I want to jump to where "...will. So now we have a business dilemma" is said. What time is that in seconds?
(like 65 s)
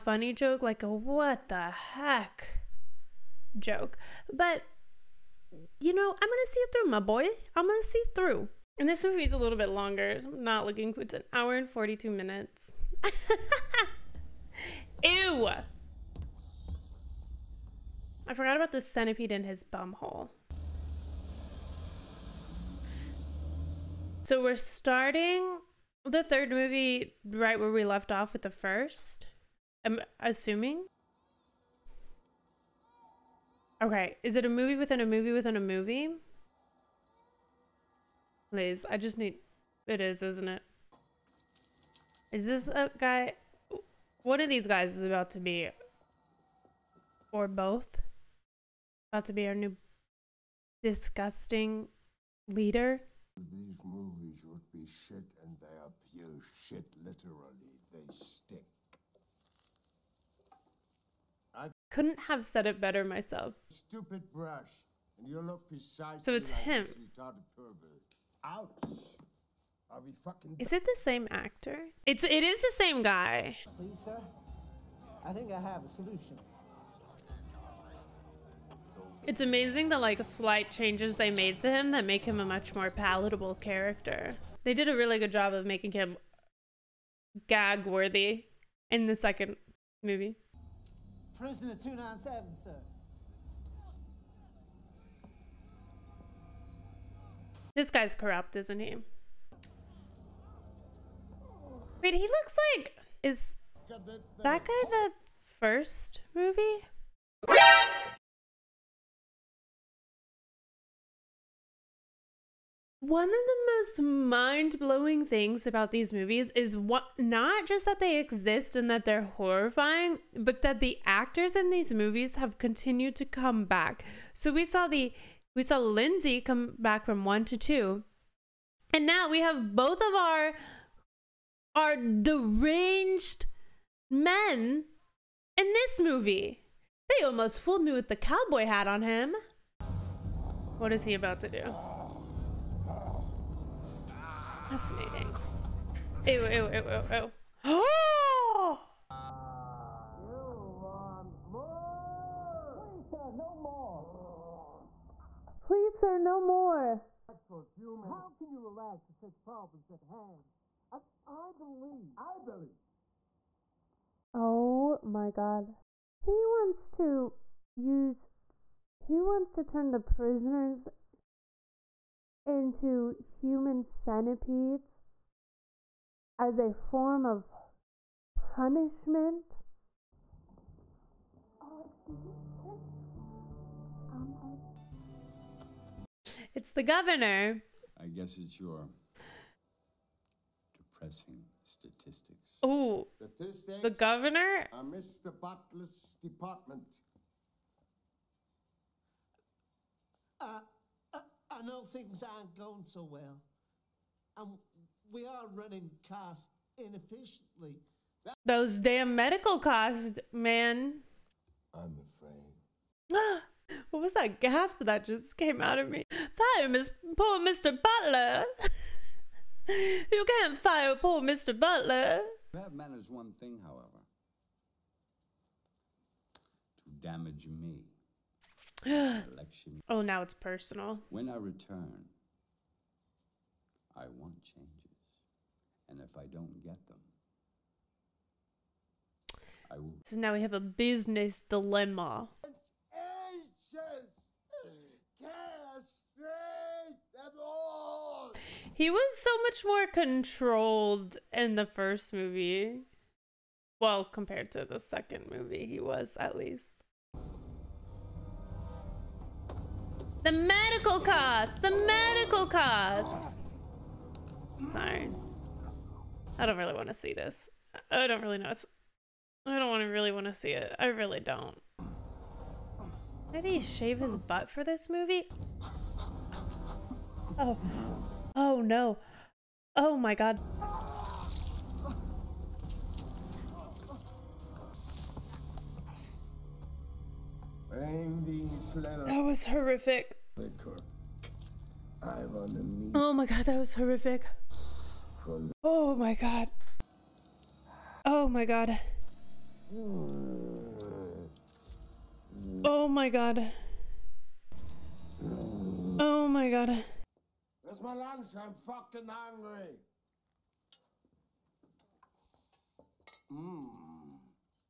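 239 s.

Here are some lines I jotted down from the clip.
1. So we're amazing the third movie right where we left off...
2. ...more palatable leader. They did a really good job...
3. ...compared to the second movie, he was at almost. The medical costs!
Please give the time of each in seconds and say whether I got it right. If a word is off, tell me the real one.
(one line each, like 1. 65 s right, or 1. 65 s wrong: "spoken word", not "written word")
1. 24 s wrong: "starting", not "amazing"
2. 82 s wrong: "character", not "leader"
3. 254 s wrong: "least", not "almost".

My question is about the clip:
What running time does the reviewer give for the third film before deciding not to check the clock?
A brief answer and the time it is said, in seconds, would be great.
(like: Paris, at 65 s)
1 hour 42 minutes, at 11 s.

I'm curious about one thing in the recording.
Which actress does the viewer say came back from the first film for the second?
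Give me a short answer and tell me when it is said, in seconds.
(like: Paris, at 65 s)
Lindsay, at 125 s.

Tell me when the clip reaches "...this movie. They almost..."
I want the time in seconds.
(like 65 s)
135 s.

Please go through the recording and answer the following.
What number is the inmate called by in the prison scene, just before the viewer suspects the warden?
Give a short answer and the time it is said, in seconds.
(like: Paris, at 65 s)
297, at 91 s.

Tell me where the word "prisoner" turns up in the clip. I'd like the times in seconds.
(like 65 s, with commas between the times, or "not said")
91 s, 169 s.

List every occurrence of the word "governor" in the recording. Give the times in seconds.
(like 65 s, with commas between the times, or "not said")
186 s, 193 s.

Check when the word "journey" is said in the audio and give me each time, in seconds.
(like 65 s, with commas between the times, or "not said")
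not said.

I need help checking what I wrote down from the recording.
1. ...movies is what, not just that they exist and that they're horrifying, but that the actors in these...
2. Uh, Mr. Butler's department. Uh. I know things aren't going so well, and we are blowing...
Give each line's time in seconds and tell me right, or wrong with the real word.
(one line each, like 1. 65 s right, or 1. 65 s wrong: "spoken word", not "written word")
1. 116 s right
2. 194 s wrong: "running", not "blowing".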